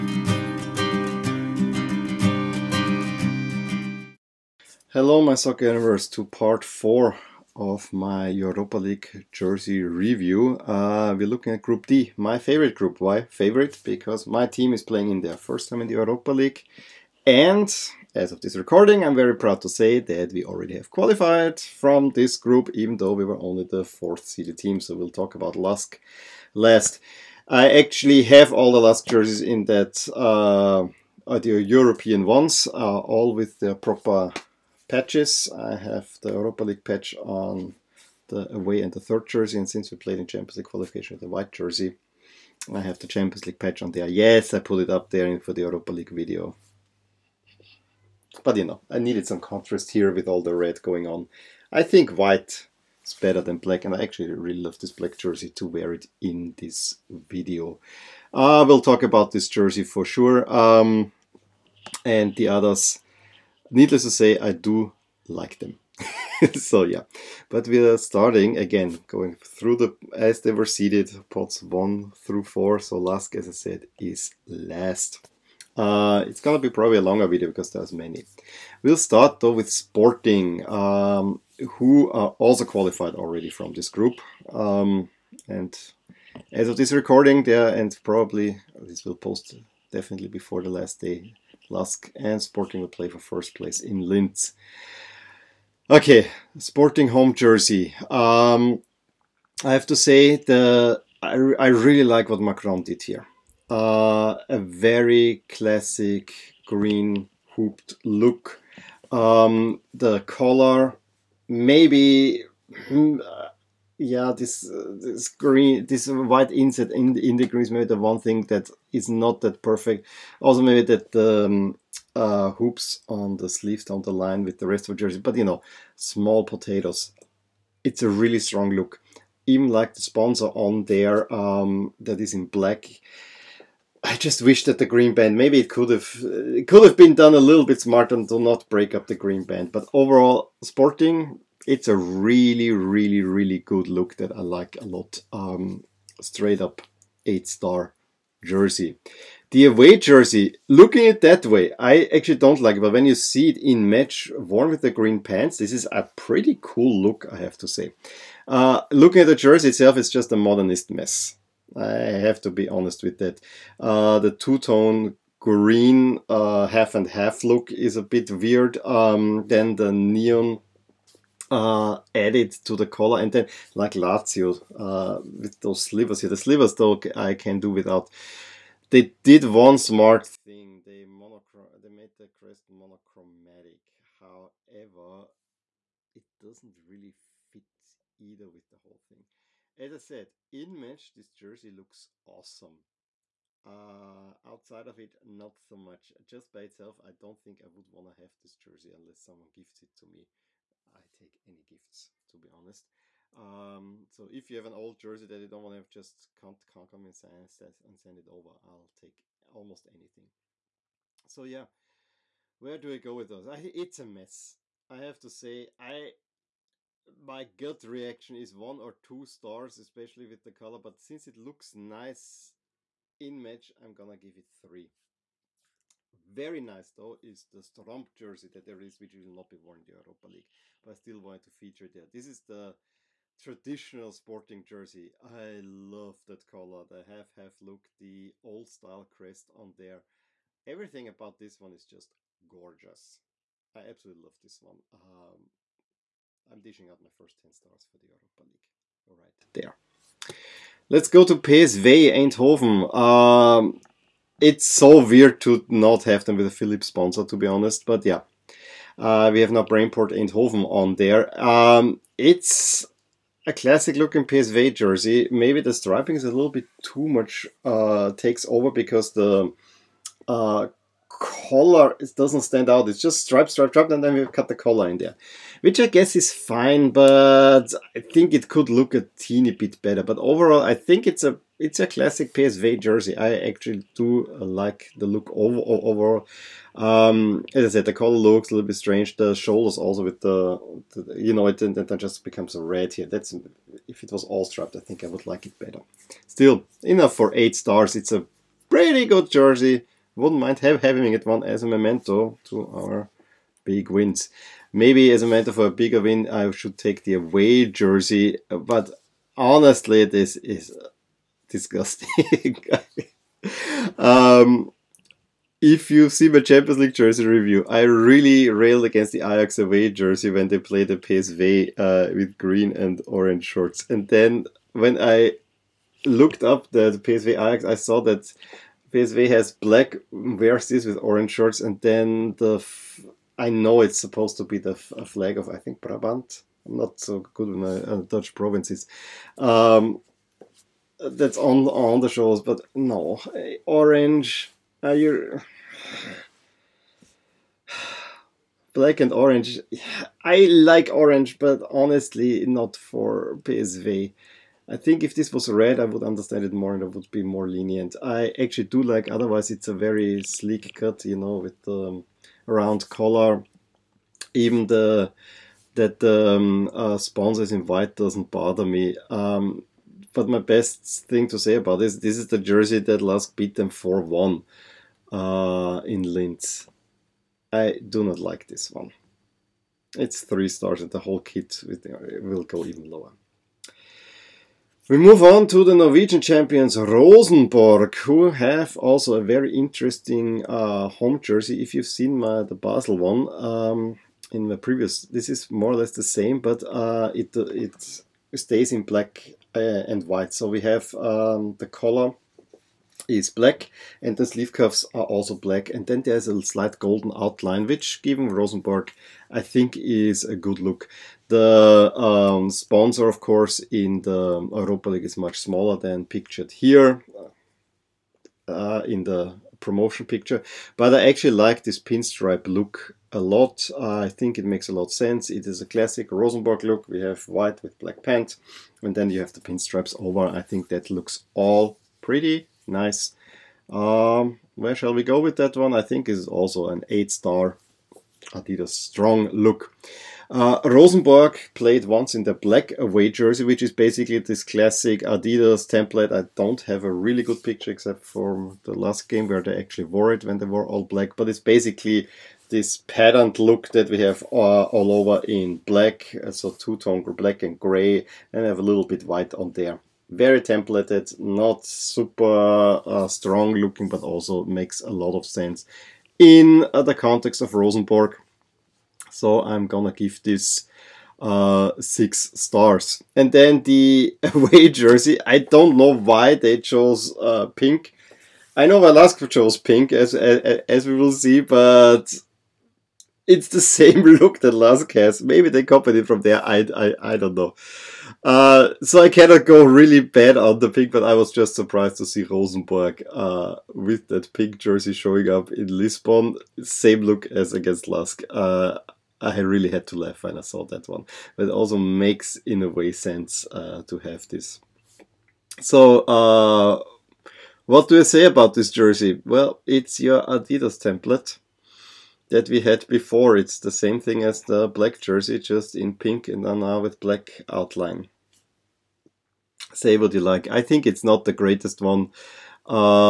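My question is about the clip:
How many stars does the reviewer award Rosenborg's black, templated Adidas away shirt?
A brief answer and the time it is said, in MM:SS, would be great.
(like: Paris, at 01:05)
6, at 07:51.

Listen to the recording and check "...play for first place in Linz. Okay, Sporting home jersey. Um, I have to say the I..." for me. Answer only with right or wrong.
right.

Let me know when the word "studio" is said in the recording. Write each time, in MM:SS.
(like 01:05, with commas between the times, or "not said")
not said.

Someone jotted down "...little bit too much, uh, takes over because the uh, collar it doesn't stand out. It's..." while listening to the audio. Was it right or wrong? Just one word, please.
right.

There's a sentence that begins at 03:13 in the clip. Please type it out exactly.
Uh, outside of it, not so much.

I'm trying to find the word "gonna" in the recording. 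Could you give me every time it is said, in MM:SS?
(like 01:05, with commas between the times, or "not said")
01:16, 03:43, 07:49.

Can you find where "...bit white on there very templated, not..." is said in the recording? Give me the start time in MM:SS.
07:38.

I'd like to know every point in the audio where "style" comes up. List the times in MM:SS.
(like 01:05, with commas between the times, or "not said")
03:58.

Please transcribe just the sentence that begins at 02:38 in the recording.
Uh, looking at the jersey itself, it's just a modernist mess.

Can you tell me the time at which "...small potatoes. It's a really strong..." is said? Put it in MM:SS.
02:05.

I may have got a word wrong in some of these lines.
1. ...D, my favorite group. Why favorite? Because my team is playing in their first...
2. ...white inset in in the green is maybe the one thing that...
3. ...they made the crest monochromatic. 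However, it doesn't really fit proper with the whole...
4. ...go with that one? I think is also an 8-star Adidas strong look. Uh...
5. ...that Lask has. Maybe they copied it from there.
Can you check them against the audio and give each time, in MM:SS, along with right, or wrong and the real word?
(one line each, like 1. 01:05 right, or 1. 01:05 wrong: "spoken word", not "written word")
1. 00:11 right
2. 01:56 right
3. 03:01 wrong: "either", not "proper"
4. 07:15 right
5. 08:04 right.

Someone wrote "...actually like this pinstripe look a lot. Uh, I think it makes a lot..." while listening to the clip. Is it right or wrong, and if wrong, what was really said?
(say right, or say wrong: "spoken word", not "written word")
right.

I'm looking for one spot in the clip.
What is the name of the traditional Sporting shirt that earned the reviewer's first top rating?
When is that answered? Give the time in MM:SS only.
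03:47.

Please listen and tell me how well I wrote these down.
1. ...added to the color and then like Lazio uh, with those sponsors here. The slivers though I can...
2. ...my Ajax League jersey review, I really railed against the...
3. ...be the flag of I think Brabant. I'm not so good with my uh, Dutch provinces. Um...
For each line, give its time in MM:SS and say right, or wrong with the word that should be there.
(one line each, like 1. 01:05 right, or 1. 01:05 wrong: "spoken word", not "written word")
1. 02:52 wrong: "slivers", not "sponsors"
2. 05:16 wrong: "Champions", not "Ajax"
3. 05:34 right.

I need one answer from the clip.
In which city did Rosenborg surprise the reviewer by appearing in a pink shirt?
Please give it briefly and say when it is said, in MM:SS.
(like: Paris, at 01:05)
Lisbon, at 08:15.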